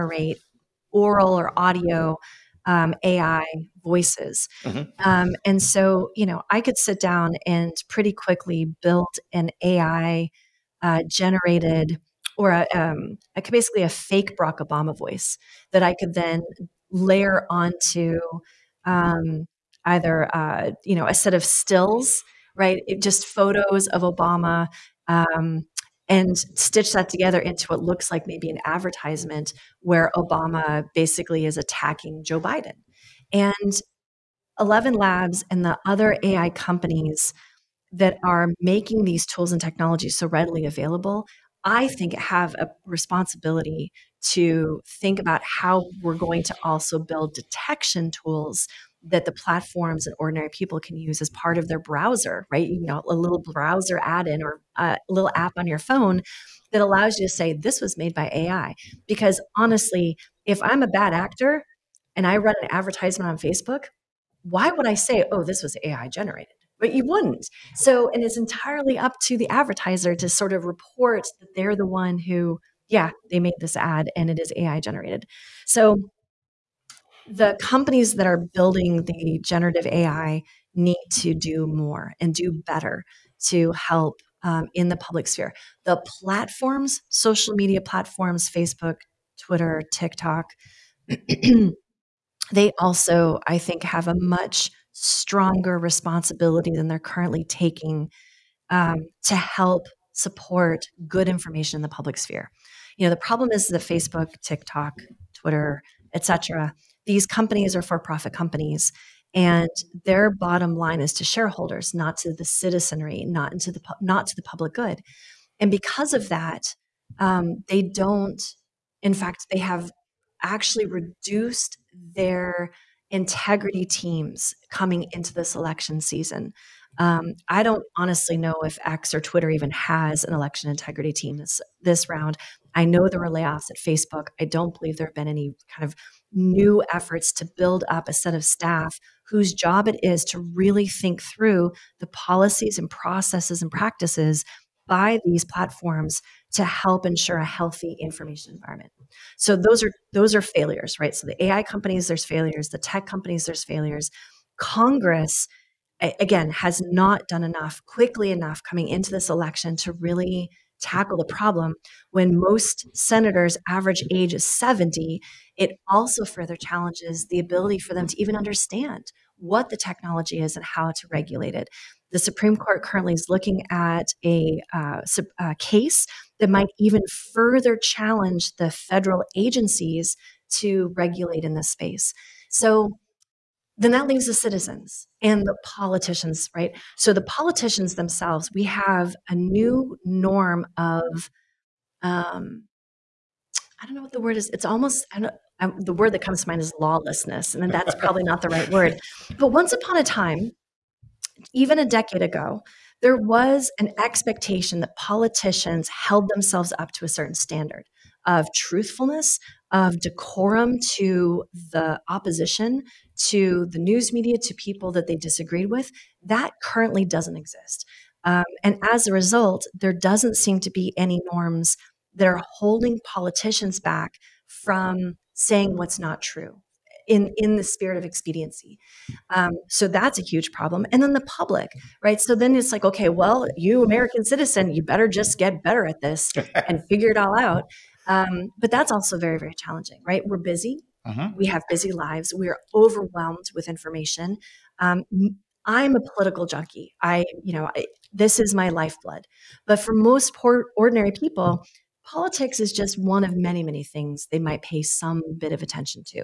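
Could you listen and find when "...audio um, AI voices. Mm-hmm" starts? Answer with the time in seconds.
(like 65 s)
1 s.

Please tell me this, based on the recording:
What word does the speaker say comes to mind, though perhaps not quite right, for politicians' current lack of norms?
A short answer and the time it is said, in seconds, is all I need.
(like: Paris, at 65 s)
lawlessness, at 196 s.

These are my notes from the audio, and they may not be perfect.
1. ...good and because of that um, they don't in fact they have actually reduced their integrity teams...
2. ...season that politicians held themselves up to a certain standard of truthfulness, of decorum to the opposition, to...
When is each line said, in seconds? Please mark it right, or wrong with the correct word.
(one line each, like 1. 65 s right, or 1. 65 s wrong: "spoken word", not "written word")
1. 114 s right
2. 204 s wrong: "expectation", not "season".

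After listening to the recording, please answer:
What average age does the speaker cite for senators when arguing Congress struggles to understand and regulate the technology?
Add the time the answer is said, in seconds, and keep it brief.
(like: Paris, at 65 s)
70, at 164 s.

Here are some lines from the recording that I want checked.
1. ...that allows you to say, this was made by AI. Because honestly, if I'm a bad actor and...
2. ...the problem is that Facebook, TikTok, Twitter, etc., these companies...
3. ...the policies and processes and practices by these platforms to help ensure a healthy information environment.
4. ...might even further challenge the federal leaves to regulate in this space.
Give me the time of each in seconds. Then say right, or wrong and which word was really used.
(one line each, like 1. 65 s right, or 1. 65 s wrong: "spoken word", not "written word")
1. 56 s right
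2. 103 s right
3. 141 s right
4. 176 s wrong: "agencies", not "leaves".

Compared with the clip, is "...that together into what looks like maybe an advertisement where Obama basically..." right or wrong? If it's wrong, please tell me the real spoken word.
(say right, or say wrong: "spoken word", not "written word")
right.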